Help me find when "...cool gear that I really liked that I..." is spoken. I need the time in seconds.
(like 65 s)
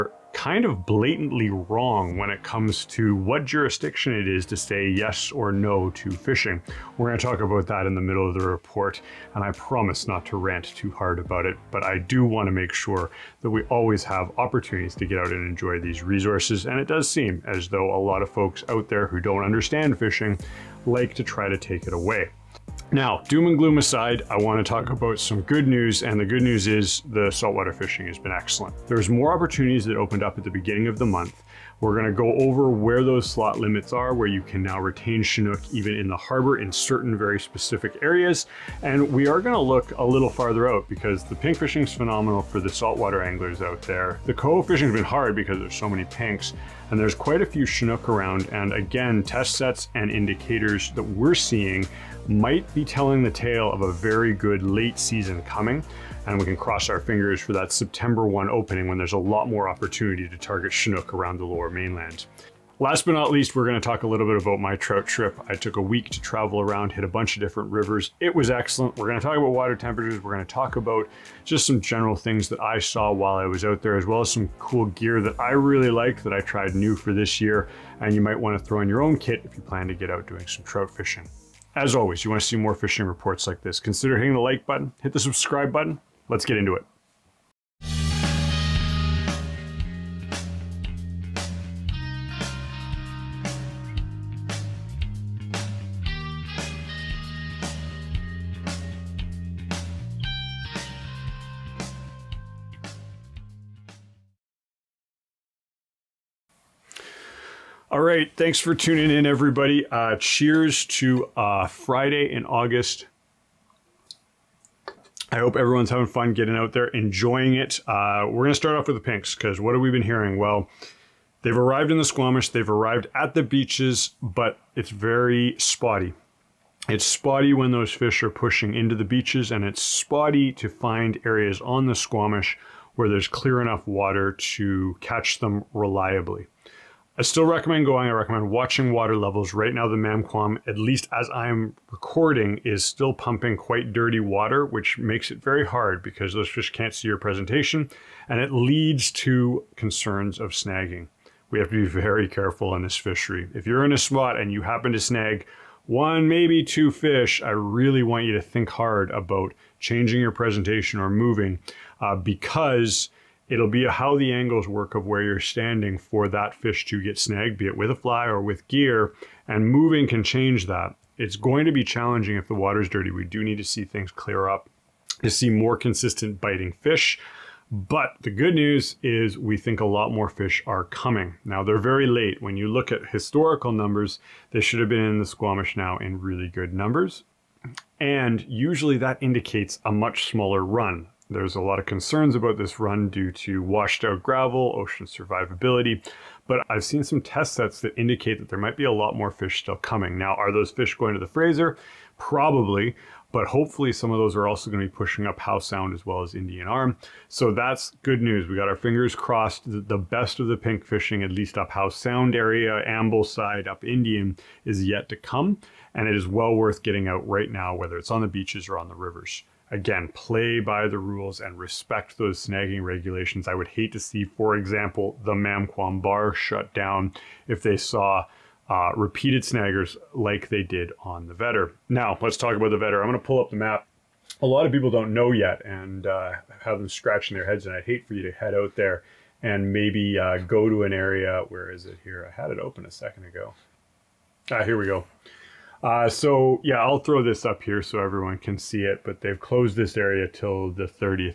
74 s.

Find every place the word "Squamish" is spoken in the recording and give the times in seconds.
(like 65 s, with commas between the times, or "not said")
122 s, 131 s, 185 s.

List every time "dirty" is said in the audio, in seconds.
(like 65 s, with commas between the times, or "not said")
143 s, 172 s.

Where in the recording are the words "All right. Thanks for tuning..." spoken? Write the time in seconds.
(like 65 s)
107 s.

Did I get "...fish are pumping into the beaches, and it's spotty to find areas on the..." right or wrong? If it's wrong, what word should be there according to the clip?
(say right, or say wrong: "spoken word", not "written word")
wrong: "pushing", not "pumping".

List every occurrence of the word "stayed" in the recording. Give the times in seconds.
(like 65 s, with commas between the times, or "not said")
not said.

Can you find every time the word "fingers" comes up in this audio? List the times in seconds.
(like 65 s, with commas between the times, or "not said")
56 s, 208 s.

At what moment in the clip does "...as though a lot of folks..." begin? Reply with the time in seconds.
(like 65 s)
17 s.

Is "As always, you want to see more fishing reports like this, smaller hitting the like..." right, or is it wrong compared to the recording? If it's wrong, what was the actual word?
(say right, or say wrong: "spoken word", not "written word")
wrong: "consider", not "smaller".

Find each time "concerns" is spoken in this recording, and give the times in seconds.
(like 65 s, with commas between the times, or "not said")
149 s, 191 s.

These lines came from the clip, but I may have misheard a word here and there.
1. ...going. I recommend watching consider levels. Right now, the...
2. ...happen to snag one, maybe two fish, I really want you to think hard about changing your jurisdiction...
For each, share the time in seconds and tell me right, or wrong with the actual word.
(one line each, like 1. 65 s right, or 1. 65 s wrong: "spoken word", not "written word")
1. 137 s wrong: "water", not "consider"
2. 154 s wrong: "presentation", not "jurisdiction".